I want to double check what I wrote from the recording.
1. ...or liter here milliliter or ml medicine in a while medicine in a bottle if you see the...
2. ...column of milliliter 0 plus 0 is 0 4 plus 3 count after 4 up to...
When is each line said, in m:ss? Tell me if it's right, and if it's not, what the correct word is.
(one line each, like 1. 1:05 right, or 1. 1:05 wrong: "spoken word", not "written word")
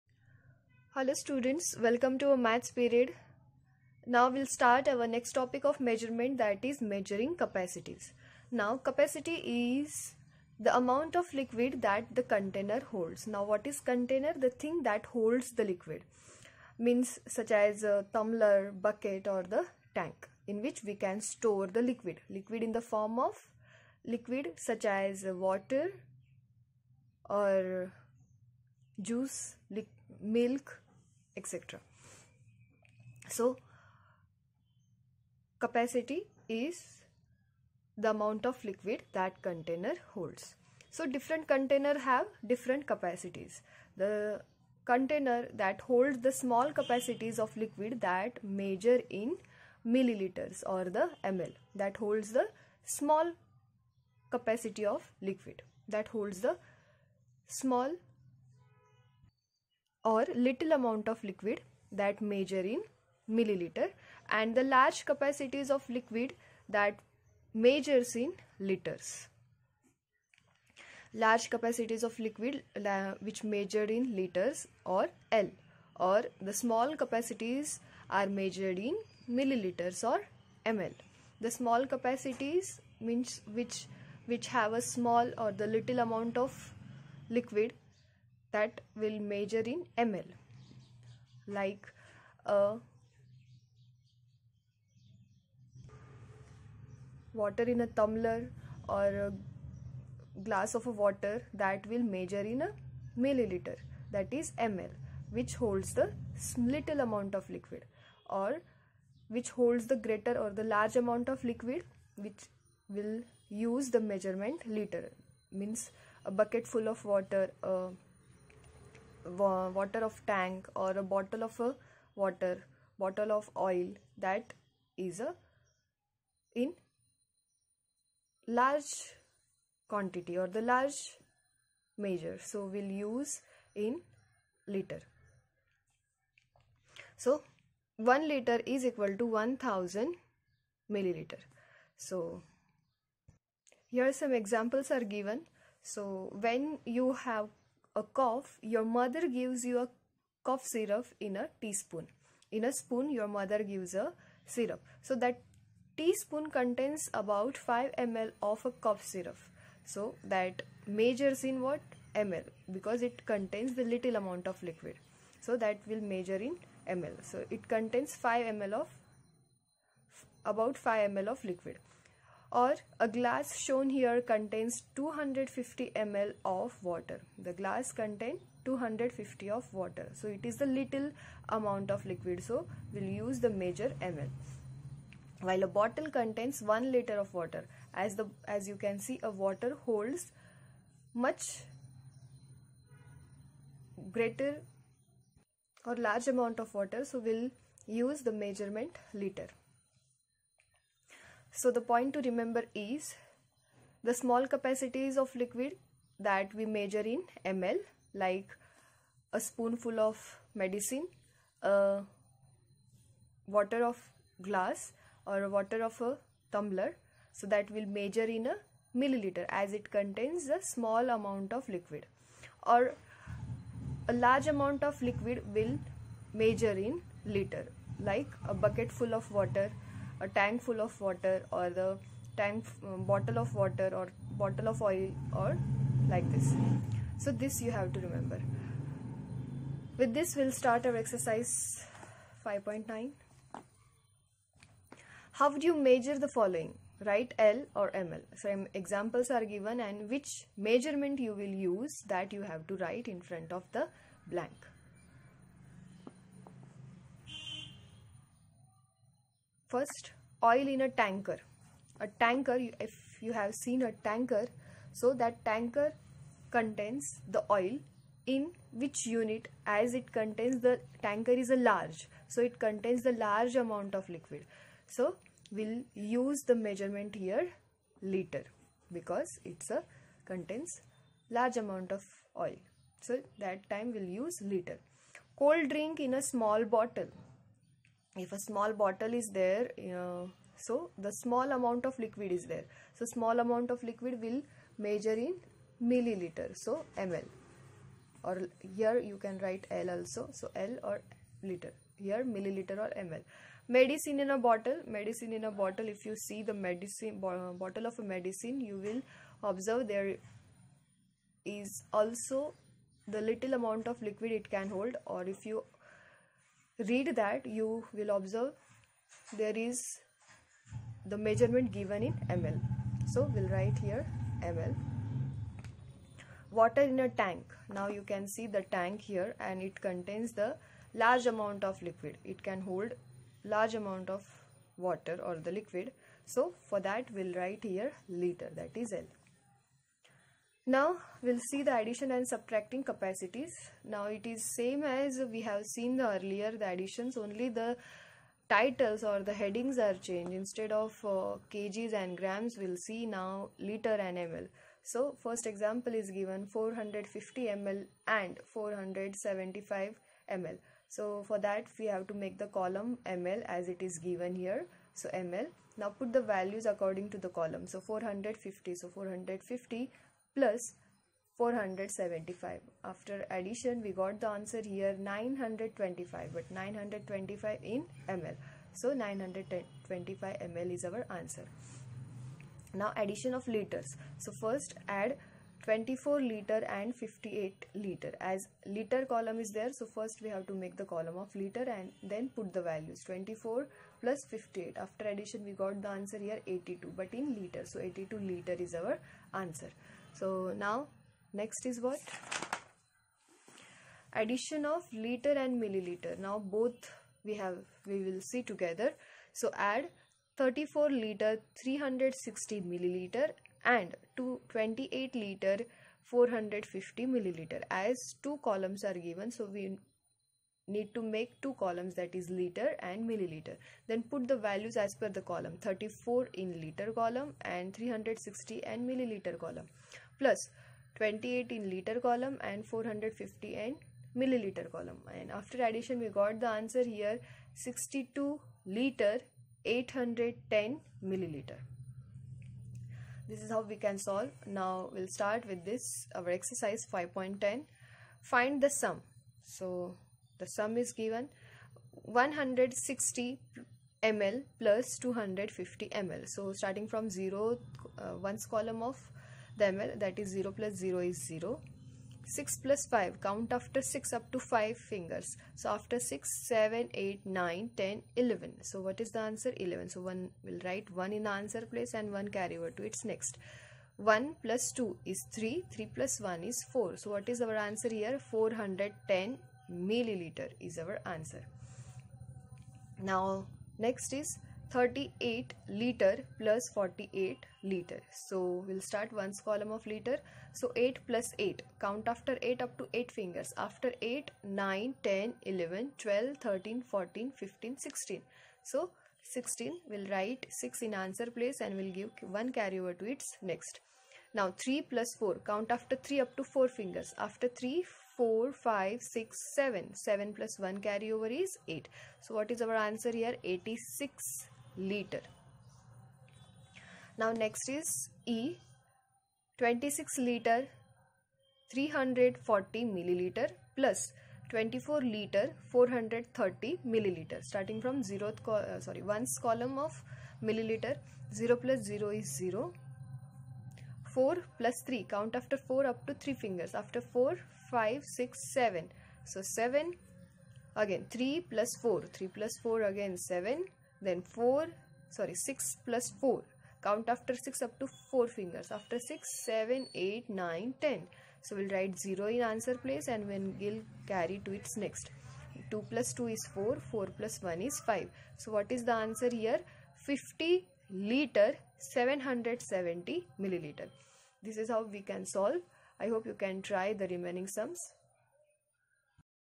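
1. 5:00 wrong: "bottle", not "while"
2. 8:49 right.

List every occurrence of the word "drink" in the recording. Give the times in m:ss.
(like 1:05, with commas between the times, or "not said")
4:45.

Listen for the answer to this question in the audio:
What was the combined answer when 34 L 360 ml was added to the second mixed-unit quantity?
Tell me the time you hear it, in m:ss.
7:17.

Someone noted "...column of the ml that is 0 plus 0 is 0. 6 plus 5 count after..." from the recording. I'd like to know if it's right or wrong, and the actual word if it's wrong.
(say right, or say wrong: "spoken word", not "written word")
right.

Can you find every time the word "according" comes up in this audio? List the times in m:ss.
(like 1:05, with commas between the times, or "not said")
6:06.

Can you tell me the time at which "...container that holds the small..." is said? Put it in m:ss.
0:44.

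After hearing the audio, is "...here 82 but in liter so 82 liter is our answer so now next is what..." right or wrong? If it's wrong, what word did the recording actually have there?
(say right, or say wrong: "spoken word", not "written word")
right.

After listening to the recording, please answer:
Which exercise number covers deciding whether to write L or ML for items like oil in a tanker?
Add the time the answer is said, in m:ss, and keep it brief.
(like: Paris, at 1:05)
5.9, at 4:02.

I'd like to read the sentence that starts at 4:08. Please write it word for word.
So examples are given and which measurement you will use that you have to write in front of the blank.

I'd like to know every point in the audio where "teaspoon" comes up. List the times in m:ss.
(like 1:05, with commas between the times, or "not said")
2:31, 2:35.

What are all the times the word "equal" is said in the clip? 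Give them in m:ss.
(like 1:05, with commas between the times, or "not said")
2:18.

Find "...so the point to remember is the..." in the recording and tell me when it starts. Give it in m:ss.
3:21.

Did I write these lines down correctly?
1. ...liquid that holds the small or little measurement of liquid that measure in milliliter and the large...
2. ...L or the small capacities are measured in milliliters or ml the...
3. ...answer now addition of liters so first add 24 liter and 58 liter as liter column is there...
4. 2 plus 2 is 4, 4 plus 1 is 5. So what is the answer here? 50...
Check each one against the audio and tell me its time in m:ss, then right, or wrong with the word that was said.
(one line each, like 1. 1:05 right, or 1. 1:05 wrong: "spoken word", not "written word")
1. 0:55 wrong: "amount", not "measurement"
2. 1:15 right
3. 6:21 right
4. 9:15 right.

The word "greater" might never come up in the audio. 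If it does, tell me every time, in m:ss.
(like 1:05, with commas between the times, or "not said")
1:50, 3:14.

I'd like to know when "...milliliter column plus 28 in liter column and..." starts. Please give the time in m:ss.
7:08.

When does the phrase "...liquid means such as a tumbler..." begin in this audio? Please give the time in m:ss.
0:15.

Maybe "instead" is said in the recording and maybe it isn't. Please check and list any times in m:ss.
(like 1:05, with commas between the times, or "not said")
5:50.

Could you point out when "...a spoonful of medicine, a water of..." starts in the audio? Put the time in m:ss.
3:29.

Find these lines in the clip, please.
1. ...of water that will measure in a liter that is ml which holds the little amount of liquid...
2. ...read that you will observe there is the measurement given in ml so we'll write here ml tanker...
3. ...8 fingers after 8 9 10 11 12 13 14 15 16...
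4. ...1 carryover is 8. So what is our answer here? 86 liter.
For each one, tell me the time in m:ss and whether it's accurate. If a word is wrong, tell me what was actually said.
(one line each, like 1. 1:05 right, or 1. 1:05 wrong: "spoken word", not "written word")
1. 1:40 wrong: "milliliter", not "liter"
2. 5:16 wrong: "water", not "tanker"
3. 8:12 right
4. 8:30 right.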